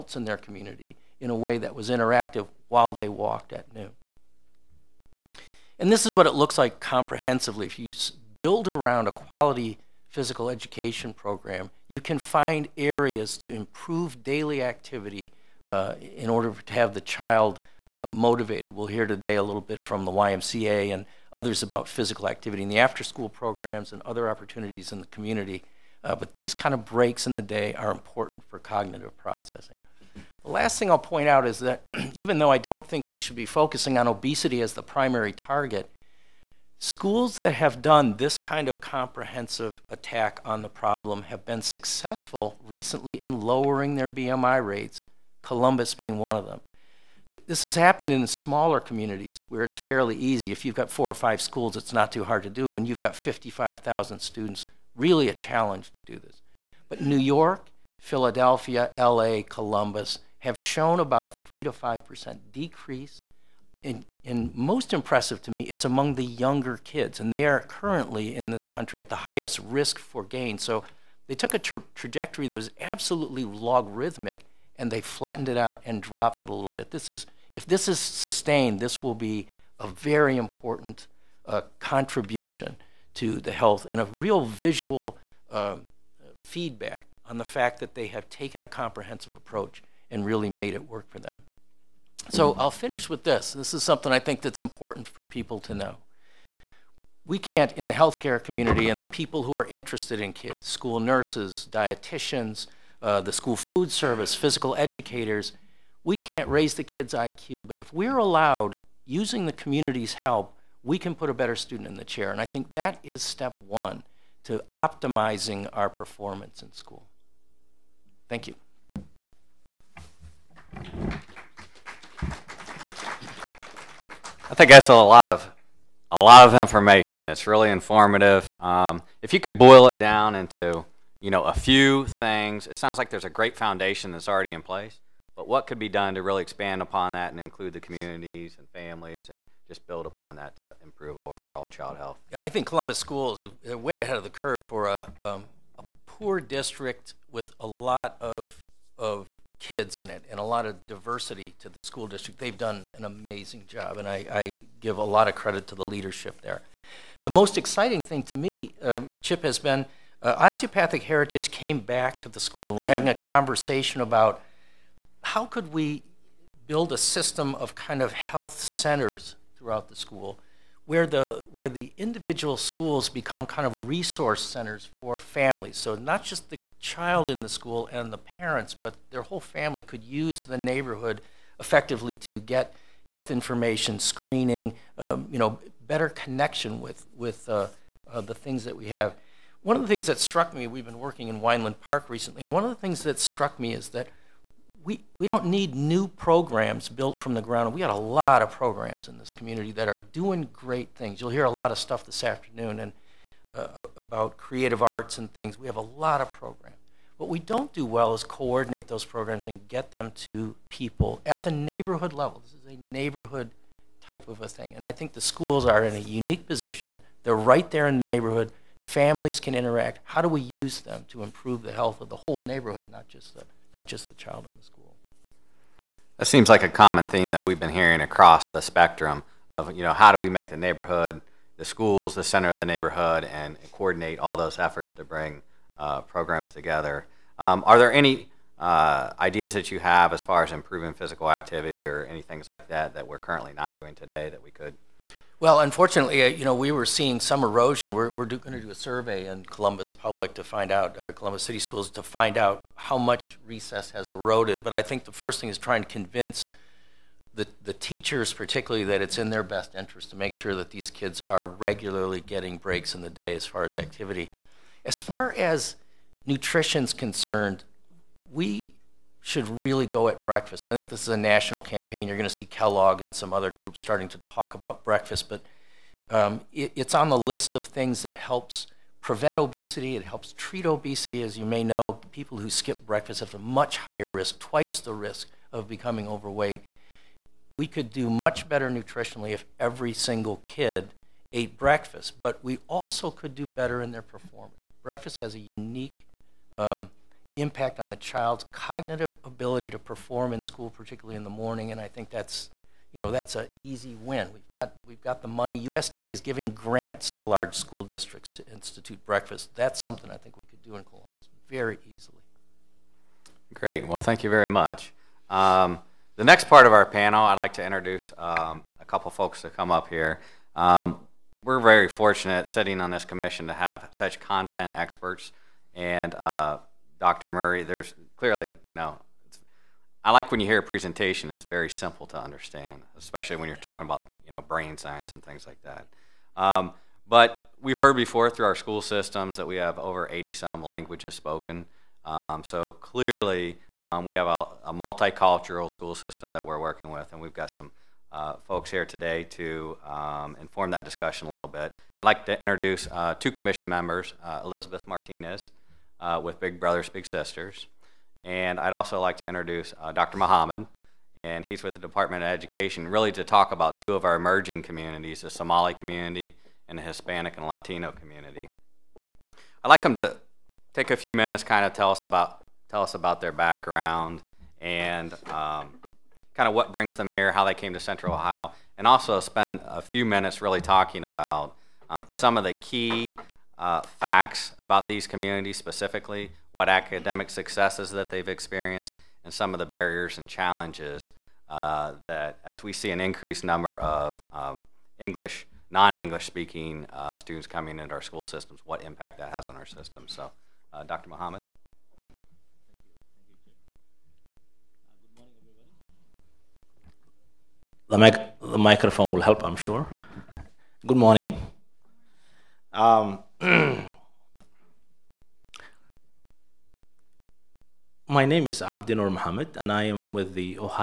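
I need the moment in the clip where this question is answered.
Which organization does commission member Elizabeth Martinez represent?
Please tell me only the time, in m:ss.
5:56.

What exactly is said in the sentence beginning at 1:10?
So they took a tra trajectory that was absolutely logarithmic, and they flattened it out and dropped it a little bit.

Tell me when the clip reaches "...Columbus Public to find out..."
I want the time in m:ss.
4:09.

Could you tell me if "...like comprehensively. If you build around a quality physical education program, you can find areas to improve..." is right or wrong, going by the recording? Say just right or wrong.
right.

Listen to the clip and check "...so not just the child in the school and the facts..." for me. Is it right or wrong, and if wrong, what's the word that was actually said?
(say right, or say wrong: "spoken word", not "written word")
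wrong: "parents", not "facts".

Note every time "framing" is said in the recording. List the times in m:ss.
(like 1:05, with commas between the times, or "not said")
not said.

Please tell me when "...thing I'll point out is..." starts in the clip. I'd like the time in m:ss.
0:30.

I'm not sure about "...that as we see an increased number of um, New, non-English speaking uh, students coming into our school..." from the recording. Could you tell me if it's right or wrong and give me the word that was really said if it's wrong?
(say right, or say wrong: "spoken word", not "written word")
wrong: "English", not "New".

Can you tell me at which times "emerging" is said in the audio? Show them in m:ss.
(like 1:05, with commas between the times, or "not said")
6:04.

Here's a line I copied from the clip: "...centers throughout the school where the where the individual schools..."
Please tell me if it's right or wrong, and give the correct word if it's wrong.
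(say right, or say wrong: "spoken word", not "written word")
right.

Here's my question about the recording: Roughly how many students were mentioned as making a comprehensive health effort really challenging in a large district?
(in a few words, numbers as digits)
55,000.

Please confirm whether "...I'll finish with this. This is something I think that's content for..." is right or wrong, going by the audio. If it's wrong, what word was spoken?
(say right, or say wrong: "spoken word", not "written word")
wrong: "important", not "content".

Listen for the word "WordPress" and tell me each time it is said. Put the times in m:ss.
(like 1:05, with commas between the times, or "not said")
not said.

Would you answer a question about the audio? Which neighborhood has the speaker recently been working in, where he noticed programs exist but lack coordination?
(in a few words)
Weinland Park.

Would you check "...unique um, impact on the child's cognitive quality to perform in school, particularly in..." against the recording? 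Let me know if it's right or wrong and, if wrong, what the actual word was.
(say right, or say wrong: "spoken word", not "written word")
wrong: "ability", not "quality".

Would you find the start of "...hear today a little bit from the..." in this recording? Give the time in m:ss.
0:18.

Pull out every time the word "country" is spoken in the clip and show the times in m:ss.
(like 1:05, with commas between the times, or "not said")
1:08.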